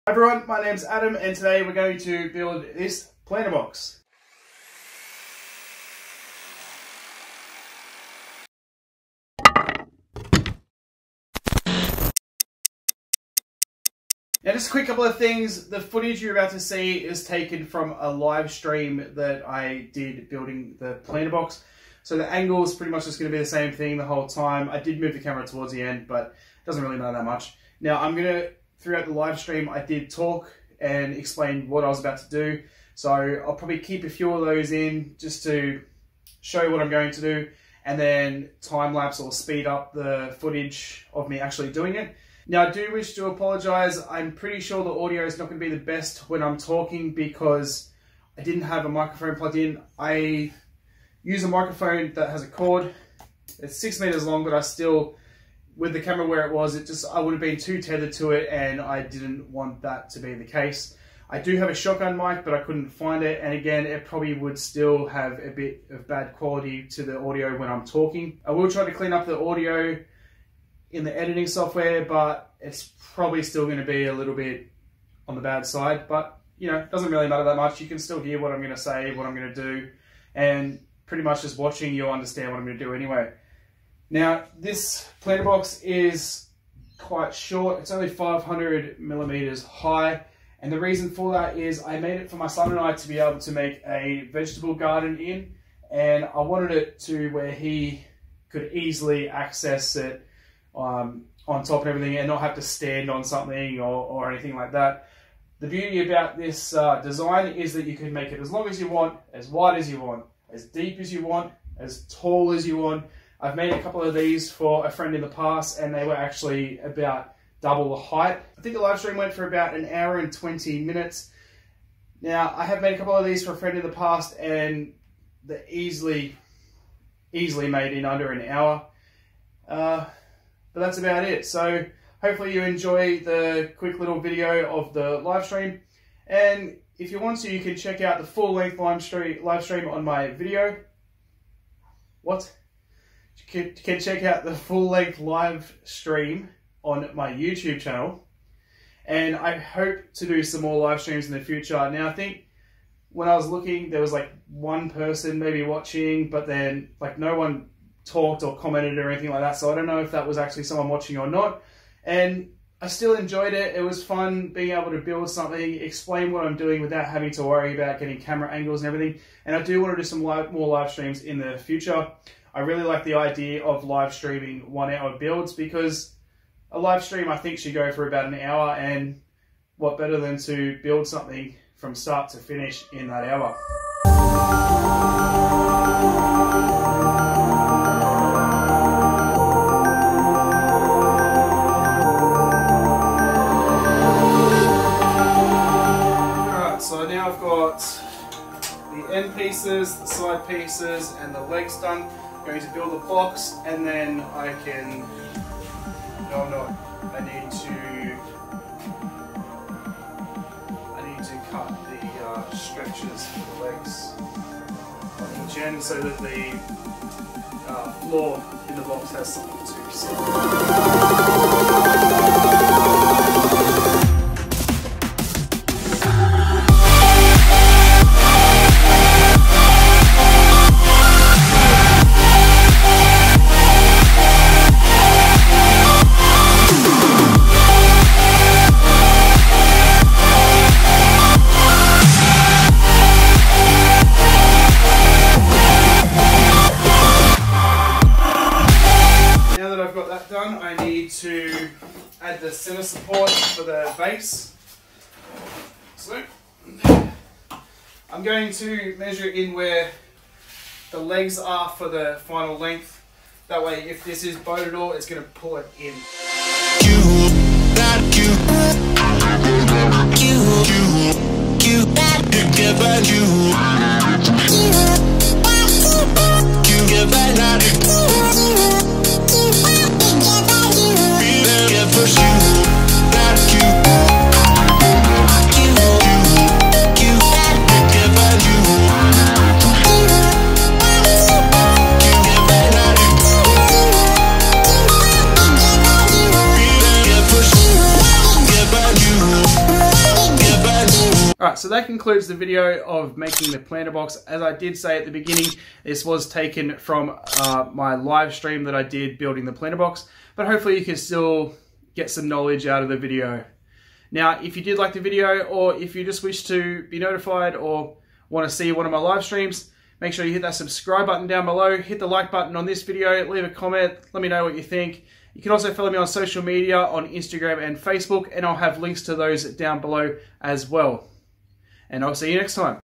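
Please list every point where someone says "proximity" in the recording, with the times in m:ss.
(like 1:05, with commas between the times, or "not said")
not said.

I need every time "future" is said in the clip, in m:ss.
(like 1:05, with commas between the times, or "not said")
2:31, 2:51.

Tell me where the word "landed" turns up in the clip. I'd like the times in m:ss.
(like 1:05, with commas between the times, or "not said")
not said.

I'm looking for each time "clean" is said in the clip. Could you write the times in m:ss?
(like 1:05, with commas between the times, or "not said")
1:08.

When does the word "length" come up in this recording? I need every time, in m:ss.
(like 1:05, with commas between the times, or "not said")
2:18, 2:24, 4:22.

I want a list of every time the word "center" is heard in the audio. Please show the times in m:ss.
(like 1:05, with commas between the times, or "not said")
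4:12.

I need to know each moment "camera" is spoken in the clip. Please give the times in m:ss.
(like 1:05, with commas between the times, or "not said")
0:25, 0:56, 2:48.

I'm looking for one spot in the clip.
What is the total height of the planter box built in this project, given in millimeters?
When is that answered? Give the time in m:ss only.
1:28.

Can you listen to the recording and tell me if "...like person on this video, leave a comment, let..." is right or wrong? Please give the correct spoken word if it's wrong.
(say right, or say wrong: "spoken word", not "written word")
wrong: "button", not "person".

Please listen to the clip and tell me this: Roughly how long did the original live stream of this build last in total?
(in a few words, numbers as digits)
About an hour and 20 minutes.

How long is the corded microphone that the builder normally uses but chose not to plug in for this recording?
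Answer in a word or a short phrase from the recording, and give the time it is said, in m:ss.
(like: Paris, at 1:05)
6 meters, at 0:53.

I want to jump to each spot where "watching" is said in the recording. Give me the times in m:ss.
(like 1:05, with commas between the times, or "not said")
1:21, 2:35, 2:40.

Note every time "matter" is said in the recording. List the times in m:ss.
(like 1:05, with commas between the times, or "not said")
0:26, 1:17.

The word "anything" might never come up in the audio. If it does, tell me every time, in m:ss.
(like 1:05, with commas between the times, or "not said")
1:44, 2:39.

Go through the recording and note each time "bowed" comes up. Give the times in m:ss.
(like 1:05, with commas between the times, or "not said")
4:24.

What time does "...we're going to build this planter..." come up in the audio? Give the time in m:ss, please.
0:01.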